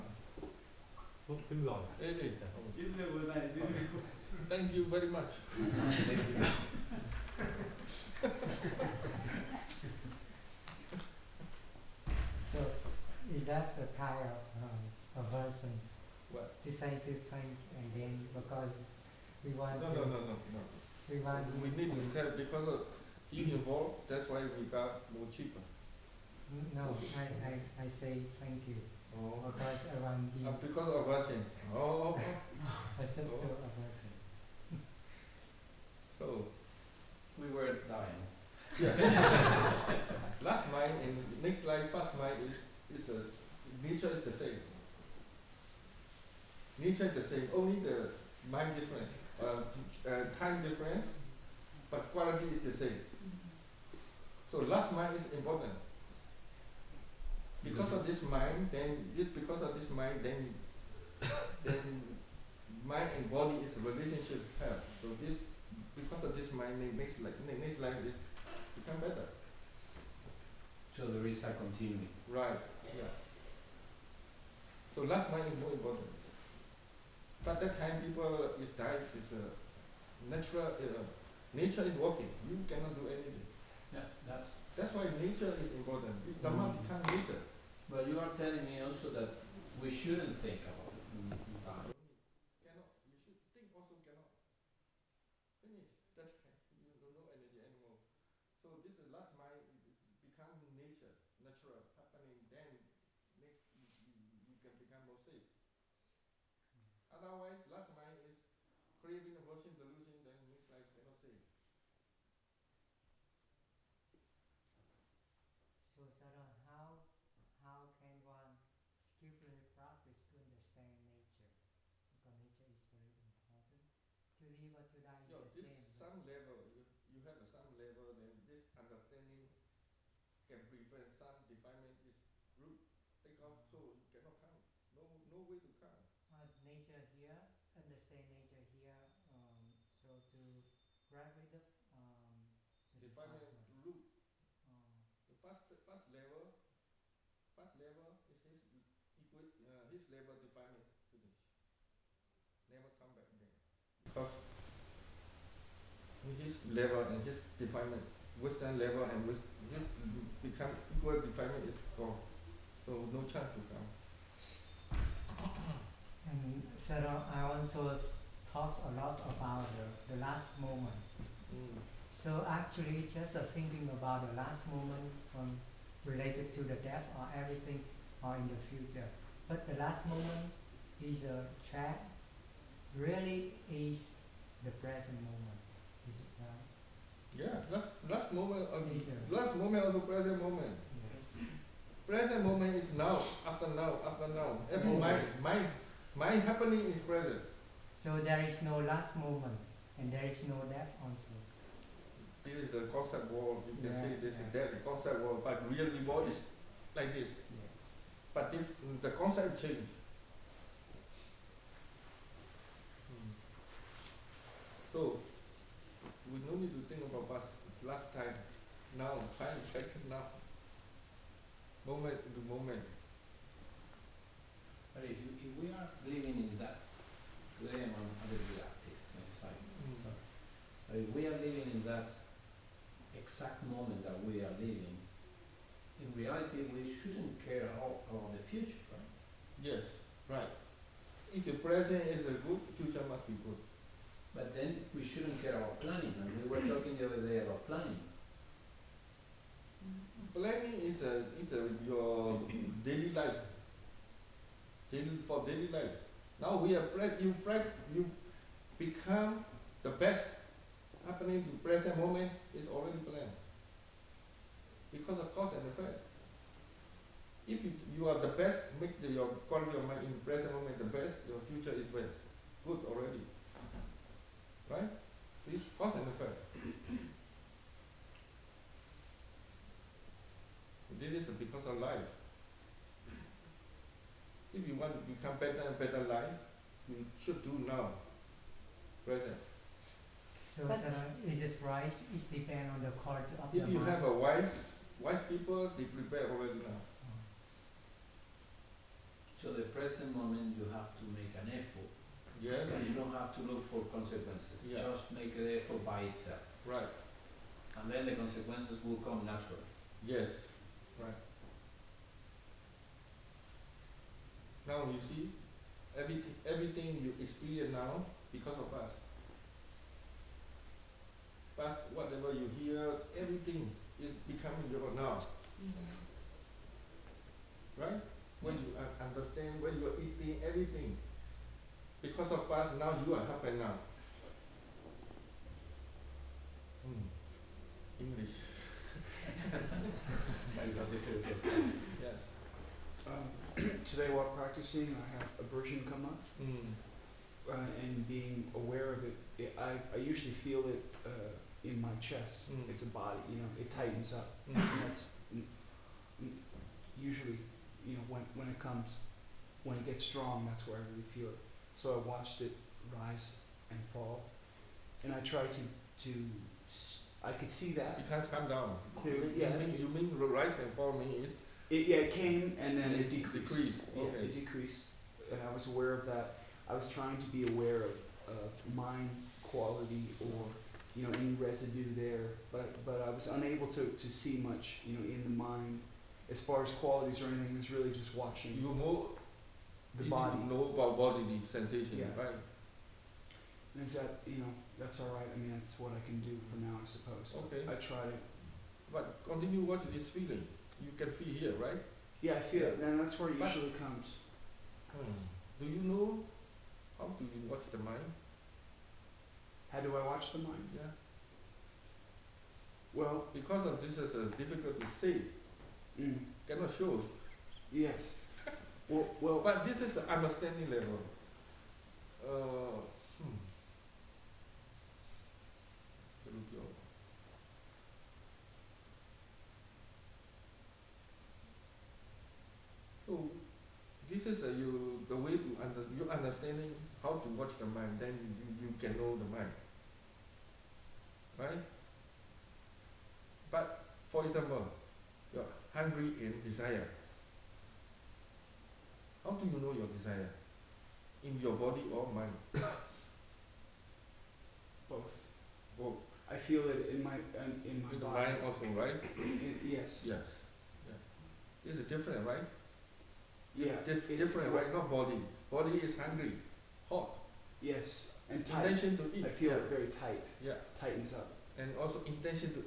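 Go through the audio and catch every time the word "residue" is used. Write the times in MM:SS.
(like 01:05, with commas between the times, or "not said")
06:21.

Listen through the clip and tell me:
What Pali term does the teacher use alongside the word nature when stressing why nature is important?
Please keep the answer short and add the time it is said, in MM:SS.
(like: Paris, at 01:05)
Dhamma, at 01:26.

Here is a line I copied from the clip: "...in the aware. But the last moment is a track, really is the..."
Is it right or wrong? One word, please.
wrong.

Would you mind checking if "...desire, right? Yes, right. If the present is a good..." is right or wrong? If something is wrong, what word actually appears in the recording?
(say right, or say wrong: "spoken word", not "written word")
wrong: "future", not "desire".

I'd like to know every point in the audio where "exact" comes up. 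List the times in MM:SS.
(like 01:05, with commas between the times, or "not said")
03:53.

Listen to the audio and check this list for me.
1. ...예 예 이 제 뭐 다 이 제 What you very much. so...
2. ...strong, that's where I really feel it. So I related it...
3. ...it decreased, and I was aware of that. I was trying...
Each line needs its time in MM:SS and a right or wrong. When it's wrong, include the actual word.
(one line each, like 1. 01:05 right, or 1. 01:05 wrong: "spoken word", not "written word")
1. 00:02 wrong: "Thank", not "What"
2. 06:00 wrong: "watched", not "related"
3. 06:14 right.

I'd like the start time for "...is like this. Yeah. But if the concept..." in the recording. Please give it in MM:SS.
03:26.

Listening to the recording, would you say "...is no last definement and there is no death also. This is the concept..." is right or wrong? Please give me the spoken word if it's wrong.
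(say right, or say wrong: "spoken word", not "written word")
wrong: "moment", not "definement".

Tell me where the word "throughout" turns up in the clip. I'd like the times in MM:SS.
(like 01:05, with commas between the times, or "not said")
not said.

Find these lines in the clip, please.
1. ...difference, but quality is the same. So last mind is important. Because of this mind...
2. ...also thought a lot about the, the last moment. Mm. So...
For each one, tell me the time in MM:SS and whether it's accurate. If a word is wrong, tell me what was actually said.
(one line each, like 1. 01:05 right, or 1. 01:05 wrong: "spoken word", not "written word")
1. 00:50 right
2. 02:47 right.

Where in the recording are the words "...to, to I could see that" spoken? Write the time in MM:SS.
06:05.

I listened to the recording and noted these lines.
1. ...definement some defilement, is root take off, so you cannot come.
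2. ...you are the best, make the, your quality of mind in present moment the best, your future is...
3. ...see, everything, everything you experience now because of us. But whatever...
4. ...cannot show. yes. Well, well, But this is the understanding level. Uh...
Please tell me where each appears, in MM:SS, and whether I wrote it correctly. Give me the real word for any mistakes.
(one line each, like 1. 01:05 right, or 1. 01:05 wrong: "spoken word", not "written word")
1. 02:10 wrong: "prevent", not "definement"
2. 04:27 right
3. 05:15 right
4. 06:56 right.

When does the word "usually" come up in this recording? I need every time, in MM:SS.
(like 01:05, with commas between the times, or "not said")
05:50, 05:57, 06:43.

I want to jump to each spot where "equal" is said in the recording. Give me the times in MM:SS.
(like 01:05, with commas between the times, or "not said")
02:29, 02:40.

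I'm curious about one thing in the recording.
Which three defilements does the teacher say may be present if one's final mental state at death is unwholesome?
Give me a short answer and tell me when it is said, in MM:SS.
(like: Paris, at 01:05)
Craving, aversion, delusion, at 01:49.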